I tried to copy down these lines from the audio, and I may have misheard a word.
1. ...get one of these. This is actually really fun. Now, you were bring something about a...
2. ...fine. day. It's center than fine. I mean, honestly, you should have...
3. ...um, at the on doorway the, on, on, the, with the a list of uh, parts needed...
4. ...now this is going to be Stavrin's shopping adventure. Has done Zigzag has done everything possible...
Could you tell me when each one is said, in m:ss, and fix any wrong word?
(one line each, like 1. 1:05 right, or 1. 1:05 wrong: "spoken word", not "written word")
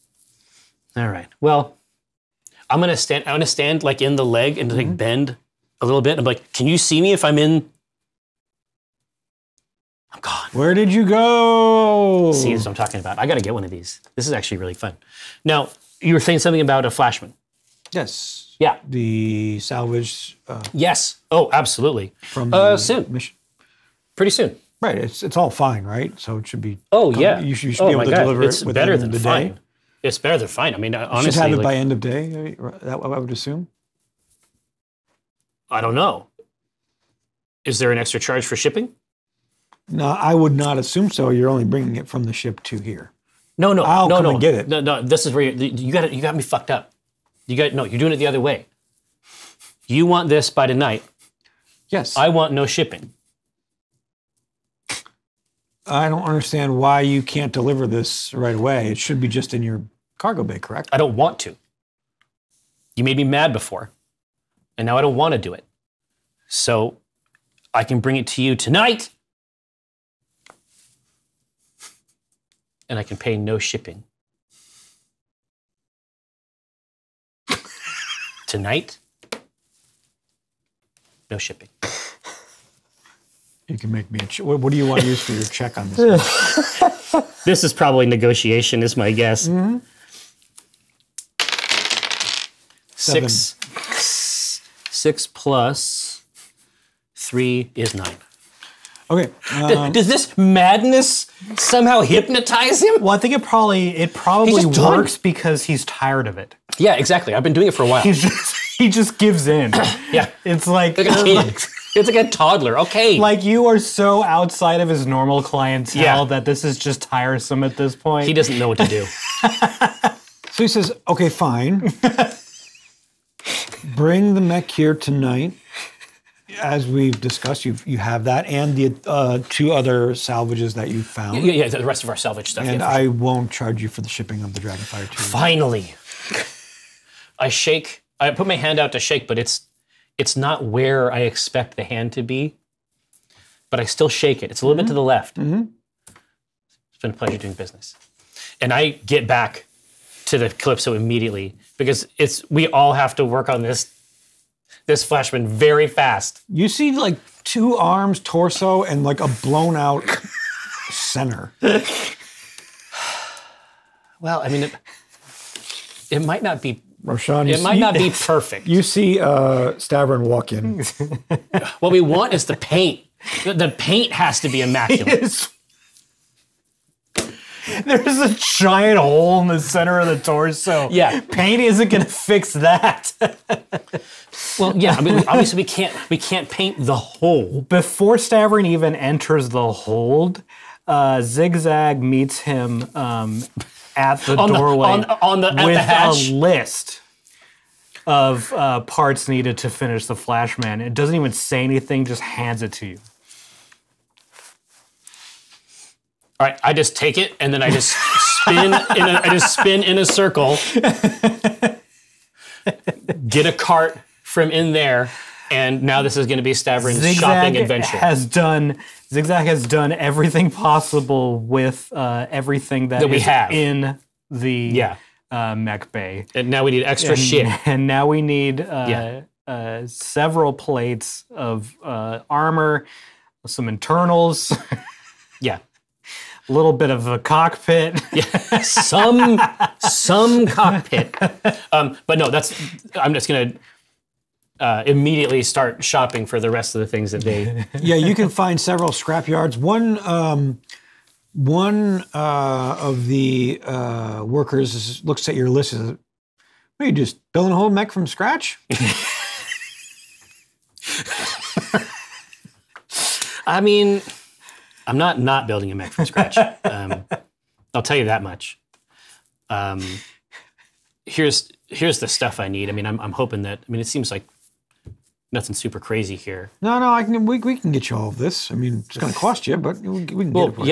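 1. 0:13 wrong: "saying", not "bring"
2. 0:29 wrong: "better", not "center"
3. 3:12 right
4. 3:35 right.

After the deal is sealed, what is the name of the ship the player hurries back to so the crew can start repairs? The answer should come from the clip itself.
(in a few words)
Calypso.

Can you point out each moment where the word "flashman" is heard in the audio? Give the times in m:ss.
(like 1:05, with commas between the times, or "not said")
0:16, 2:35, 3:20.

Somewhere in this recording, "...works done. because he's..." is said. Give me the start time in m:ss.
1:44.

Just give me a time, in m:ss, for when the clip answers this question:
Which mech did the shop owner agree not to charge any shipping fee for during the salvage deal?
2:14.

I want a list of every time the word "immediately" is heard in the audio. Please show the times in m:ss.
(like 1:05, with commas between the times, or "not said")
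2:30, 4:04.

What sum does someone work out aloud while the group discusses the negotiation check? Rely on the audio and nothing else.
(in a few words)
9.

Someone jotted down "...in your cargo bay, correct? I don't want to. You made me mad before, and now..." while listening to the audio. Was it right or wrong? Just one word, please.
right.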